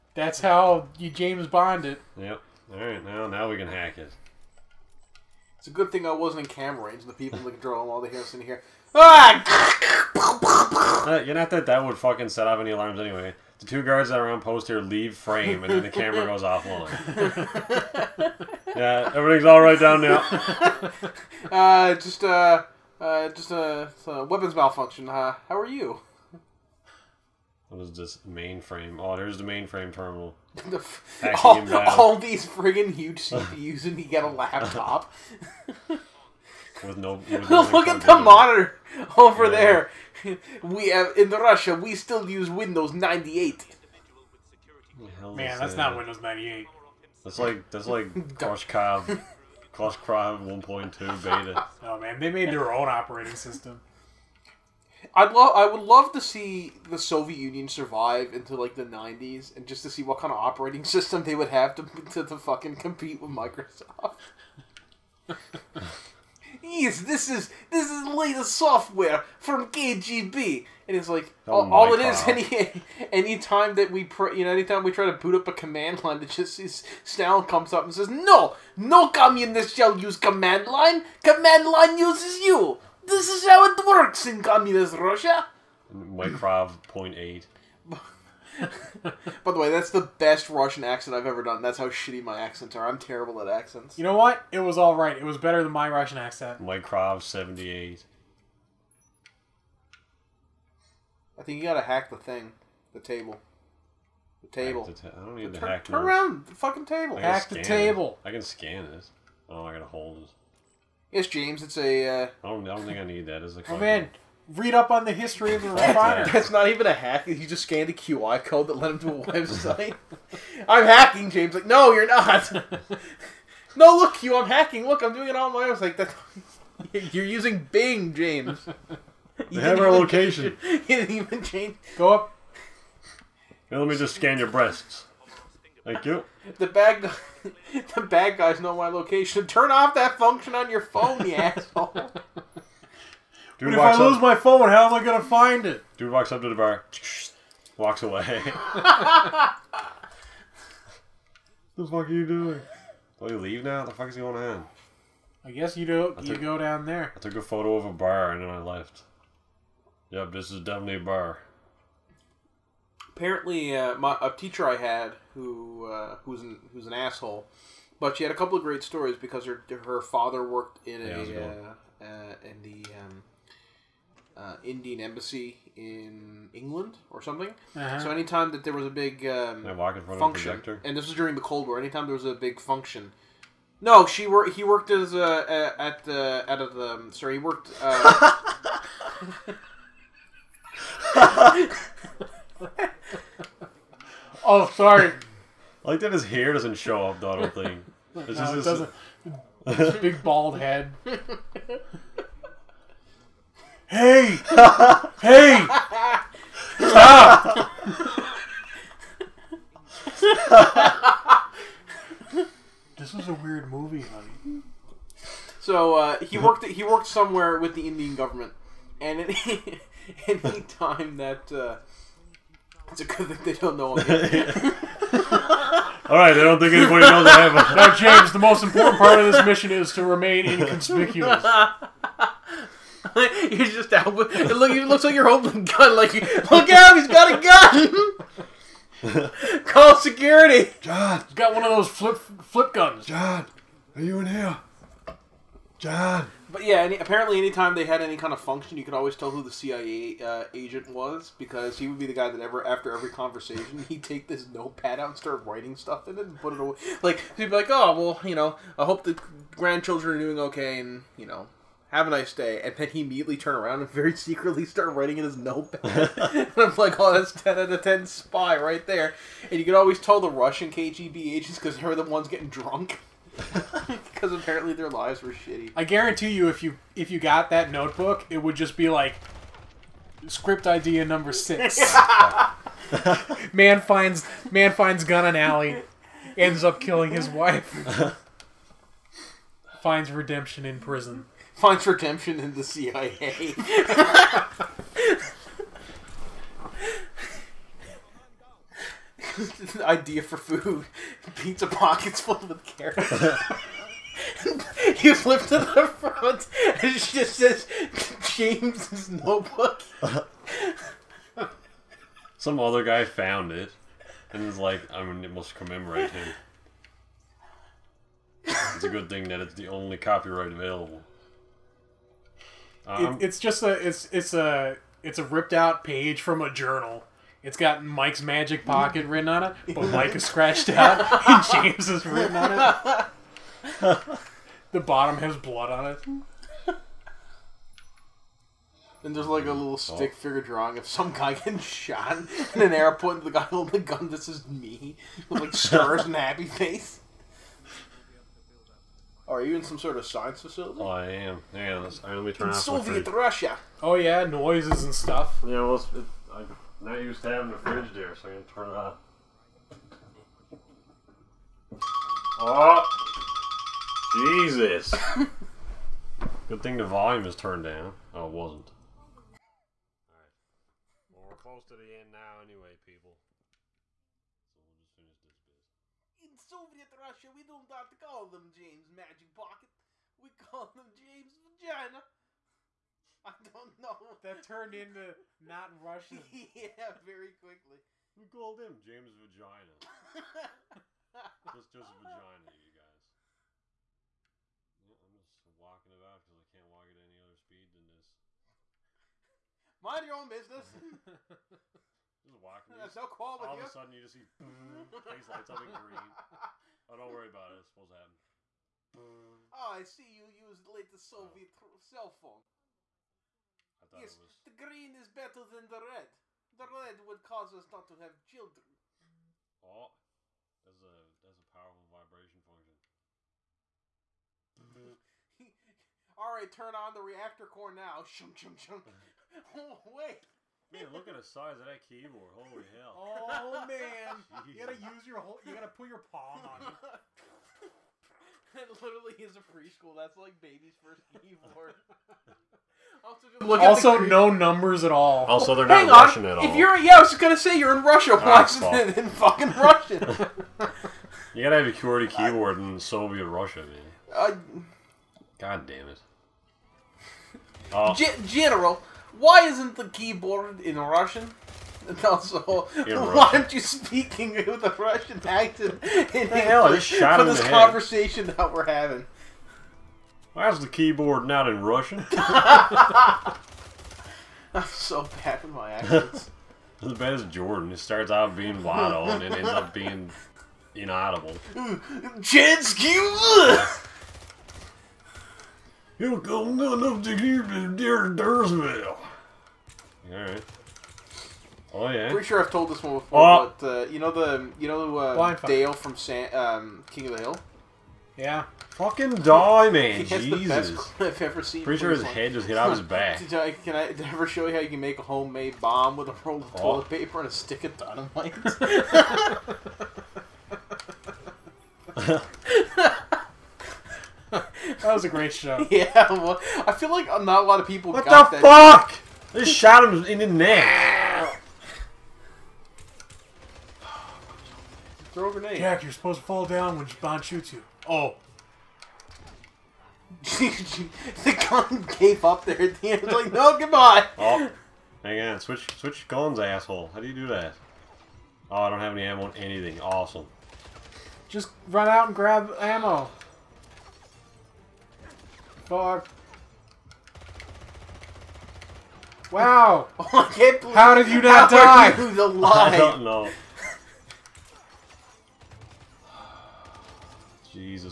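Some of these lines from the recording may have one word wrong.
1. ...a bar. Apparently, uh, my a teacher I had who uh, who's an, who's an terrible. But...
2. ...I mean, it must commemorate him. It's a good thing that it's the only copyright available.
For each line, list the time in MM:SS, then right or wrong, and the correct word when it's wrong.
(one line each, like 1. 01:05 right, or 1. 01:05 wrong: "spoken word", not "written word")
1. 02:40 wrong: "asshole", not "terrible"
2. 05:14 right.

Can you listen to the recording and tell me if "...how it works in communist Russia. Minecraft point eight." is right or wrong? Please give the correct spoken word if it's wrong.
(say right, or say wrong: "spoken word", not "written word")
right.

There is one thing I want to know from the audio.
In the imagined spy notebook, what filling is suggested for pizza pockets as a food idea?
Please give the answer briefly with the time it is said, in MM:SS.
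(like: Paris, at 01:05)
Carrots, at 05:02.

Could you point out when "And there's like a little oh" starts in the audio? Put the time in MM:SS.
05:39.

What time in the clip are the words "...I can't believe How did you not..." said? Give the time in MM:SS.
09:09.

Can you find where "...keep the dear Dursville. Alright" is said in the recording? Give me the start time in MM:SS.
08:07.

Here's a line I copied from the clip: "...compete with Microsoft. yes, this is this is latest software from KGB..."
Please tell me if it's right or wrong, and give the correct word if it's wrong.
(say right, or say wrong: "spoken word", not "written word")
right.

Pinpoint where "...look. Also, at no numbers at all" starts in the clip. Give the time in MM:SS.
07:23.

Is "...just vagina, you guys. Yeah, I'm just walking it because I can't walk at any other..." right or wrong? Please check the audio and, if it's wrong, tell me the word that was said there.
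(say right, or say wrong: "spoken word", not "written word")
right.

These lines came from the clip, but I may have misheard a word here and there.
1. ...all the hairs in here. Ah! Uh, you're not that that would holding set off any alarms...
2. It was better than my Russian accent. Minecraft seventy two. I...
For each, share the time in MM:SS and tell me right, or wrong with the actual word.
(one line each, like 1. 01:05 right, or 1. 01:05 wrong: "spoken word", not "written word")
1. 00:07 wrong: "fucking", not "holding"
2. 01:35 wrong: "eight", not "two".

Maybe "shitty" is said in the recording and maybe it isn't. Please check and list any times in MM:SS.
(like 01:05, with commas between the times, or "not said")
01:31, 04:35.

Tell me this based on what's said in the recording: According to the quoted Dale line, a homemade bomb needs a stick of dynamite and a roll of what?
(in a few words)
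Toilet paper.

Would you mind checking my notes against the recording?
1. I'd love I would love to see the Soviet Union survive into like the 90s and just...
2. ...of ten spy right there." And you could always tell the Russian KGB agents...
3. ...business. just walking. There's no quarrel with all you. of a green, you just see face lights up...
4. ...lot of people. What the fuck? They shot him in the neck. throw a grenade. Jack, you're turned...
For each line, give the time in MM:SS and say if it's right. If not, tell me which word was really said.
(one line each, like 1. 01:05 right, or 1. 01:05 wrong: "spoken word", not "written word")
1. 00:55 right
2. 04:27 right
3. 06:40 wrong: "sudden", not "green"
4. 08:37 wrong: "supposed", not "turned".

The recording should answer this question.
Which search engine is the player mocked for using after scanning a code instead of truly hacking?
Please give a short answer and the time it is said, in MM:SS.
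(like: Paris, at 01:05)
Bing, at 02:07.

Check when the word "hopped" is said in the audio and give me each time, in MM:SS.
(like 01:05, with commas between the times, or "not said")
not said.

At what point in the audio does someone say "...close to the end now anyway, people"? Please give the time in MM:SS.
06:11.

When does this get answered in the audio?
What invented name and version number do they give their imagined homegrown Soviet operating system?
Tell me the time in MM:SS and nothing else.
00:49.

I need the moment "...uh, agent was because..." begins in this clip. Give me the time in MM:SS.
04:10.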